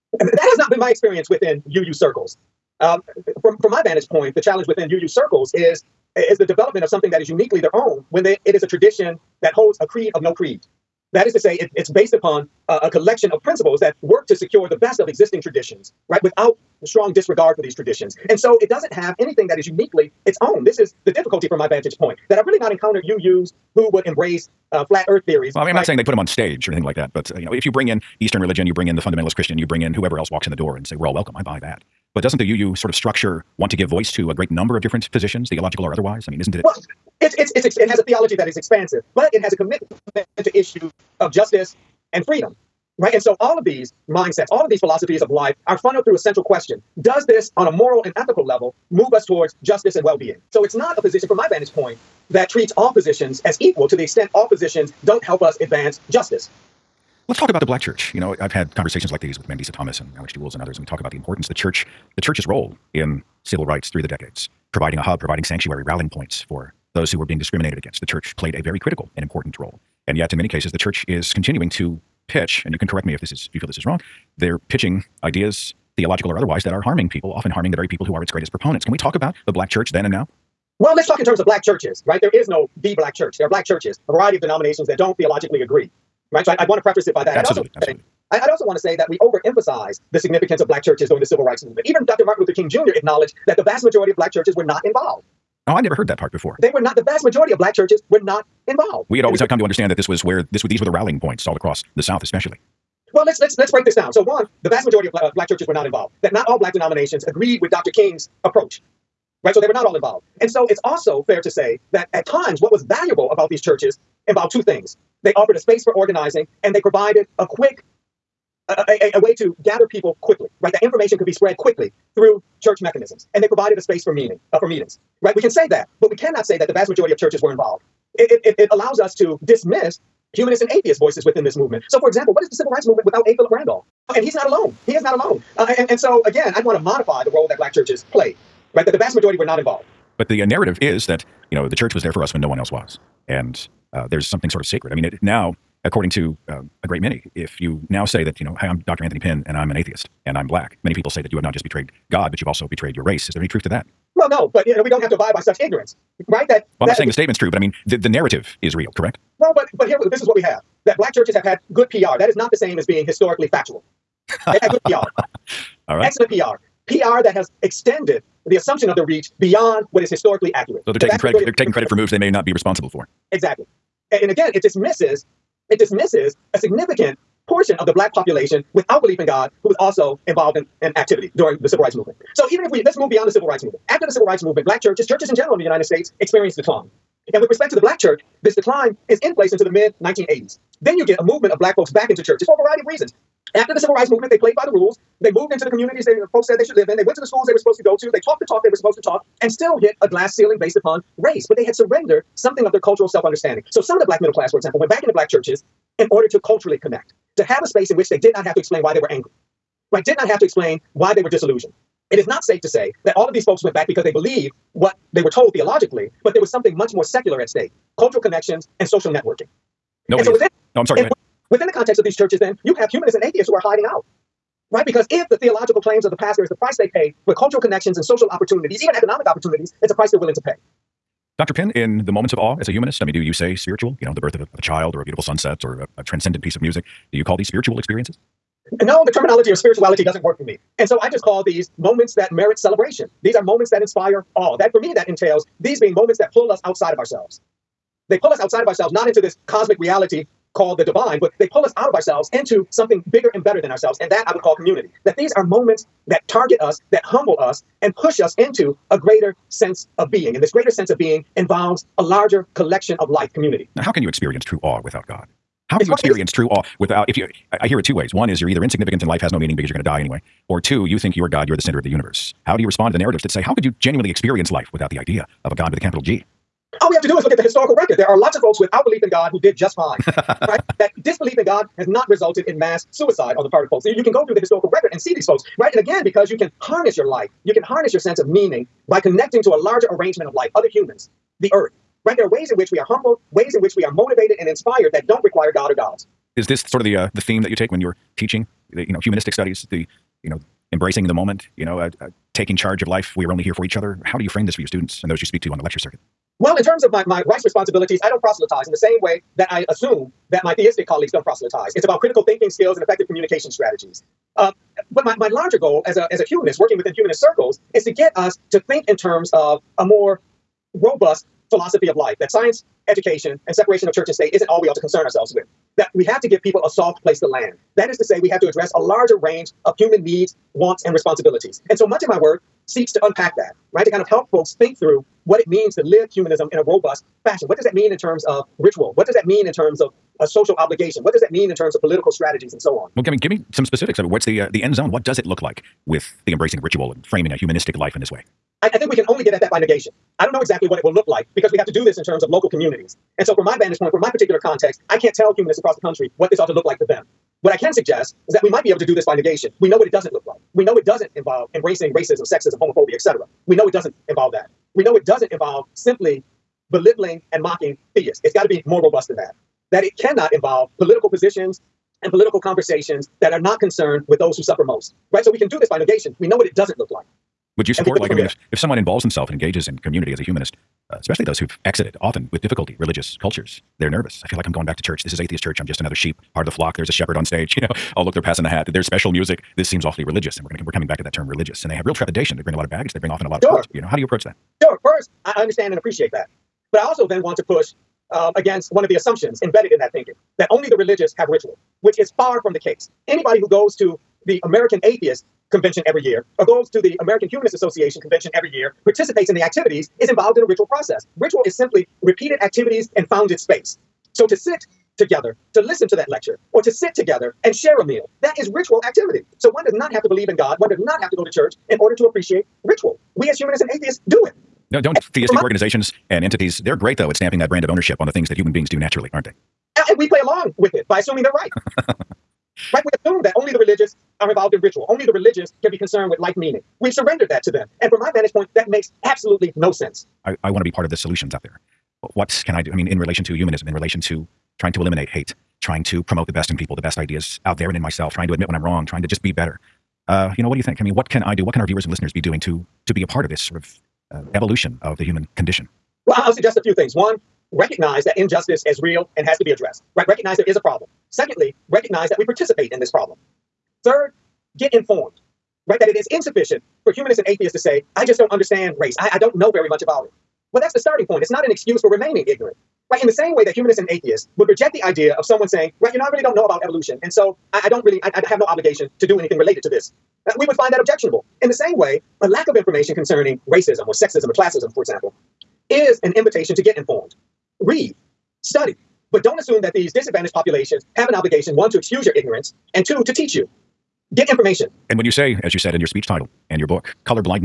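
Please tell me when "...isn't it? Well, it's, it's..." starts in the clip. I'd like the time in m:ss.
0:36.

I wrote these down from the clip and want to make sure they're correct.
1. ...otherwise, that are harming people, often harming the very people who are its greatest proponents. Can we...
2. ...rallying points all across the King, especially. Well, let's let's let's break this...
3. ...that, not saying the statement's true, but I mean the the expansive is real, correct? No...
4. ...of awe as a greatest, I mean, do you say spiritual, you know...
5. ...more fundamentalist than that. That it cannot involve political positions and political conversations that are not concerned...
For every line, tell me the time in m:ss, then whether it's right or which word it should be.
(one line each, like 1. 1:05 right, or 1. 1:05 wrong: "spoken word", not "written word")
1. 1:16 right
2. 1:40 wrong: "South", not "King"
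3. 2:36 wrong: "narrative", not "expansive"
4. 3:52 wrong: "humanist", not "greatest"
5. 6:08 wrong: "robust", not "fundamentalist".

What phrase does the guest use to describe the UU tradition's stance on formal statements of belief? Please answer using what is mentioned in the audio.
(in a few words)
a creed of no creed.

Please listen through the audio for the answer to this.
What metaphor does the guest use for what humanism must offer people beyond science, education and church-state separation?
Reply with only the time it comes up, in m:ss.
5:26.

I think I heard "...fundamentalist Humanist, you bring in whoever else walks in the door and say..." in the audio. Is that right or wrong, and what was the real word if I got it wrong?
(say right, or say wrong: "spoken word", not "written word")
wrong: "Christian", not "Humanist".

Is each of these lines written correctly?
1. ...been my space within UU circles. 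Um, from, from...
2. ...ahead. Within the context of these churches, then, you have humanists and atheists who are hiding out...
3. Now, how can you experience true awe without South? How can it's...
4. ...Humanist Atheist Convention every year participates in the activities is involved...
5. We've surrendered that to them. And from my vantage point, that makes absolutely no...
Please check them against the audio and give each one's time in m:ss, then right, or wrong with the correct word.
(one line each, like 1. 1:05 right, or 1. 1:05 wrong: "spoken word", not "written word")
1. 0:00 wrong: "experience", not "space"
2. 3:41 right
3. 4:23 wrong: "God", not "South"
4. 6:47 wrong: "Association", not "Atheist"
5. 7:16 right.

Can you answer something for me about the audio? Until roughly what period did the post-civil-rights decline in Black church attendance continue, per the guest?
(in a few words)
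mid 1980s.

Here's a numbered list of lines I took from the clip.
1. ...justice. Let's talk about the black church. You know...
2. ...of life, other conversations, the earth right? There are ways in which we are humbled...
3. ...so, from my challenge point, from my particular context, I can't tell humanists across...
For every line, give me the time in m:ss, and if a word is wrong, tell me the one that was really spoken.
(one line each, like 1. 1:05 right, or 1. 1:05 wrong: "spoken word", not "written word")
1. 0:56 right
2. 4:50 wrong: "humans", not "conversations"
3. 5:53 wrong: "vantage", not "challenge".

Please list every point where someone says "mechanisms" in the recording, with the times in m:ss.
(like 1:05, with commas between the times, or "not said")
2:02.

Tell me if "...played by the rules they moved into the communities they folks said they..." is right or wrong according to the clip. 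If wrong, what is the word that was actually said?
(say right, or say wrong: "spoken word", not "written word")
right.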